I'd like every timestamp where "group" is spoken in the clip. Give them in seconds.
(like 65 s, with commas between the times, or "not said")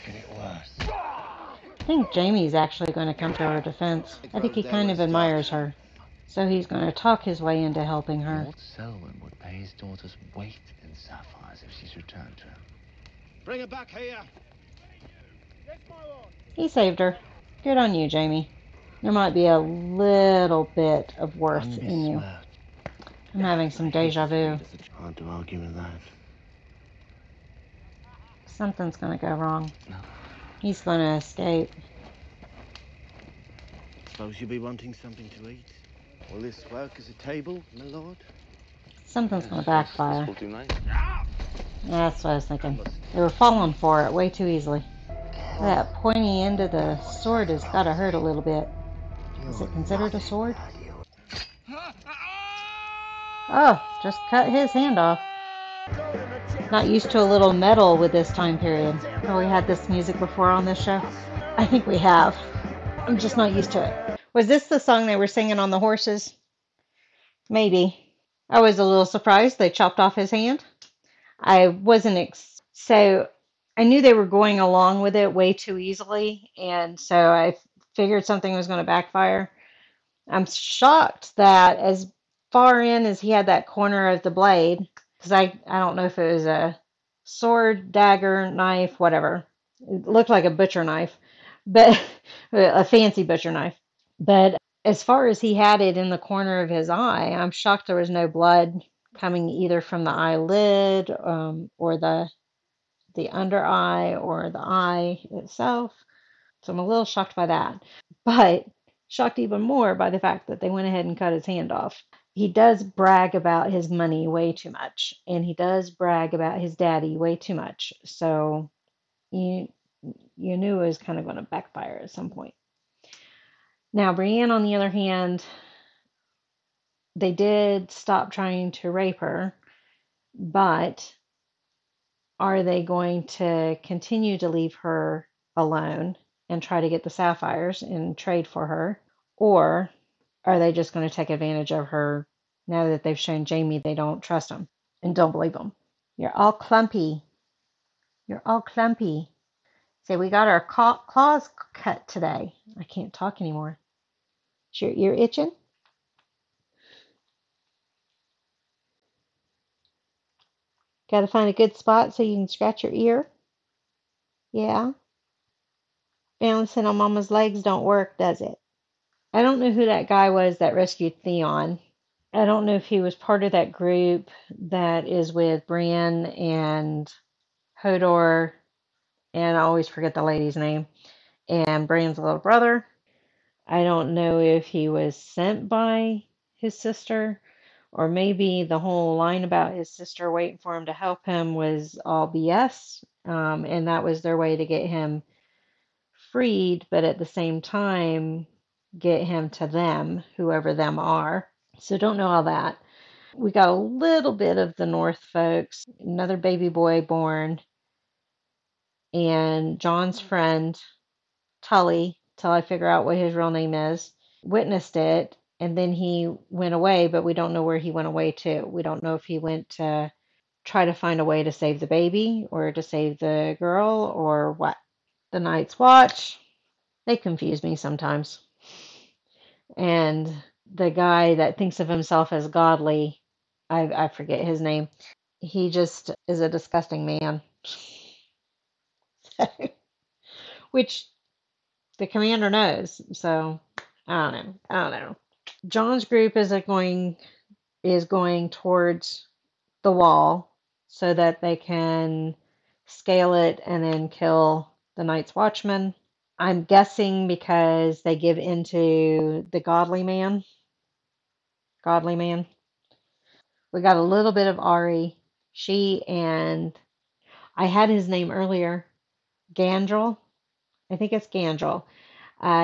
173 s, 246 s.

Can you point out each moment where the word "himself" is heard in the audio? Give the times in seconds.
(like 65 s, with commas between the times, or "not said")
231 s.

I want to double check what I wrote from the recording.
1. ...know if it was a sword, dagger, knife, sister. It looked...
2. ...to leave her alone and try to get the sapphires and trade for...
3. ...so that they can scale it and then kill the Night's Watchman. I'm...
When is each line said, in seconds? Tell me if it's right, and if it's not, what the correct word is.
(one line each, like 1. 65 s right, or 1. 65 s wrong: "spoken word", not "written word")
1. 85 s wrong: "whatever", not "sister"
2. 134 s right
3. 250 s right.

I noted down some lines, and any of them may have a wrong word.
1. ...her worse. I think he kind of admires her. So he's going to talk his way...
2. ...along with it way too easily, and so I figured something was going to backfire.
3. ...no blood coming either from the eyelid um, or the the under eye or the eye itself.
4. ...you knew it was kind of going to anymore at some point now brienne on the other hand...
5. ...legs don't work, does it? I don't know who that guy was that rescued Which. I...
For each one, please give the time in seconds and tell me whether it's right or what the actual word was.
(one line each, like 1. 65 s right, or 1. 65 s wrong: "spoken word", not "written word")
1. 3 s wrong: "defense", not "worse"
2. 74 s right
3. 98 s right
4. 120 s wrong: "backfire", not "anymore"
5. 167 s wrong: "Theon", not "Which".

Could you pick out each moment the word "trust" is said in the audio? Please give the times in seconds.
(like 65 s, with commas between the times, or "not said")
144 s.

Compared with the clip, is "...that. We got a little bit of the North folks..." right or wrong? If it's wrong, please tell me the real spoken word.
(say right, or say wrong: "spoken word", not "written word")
right.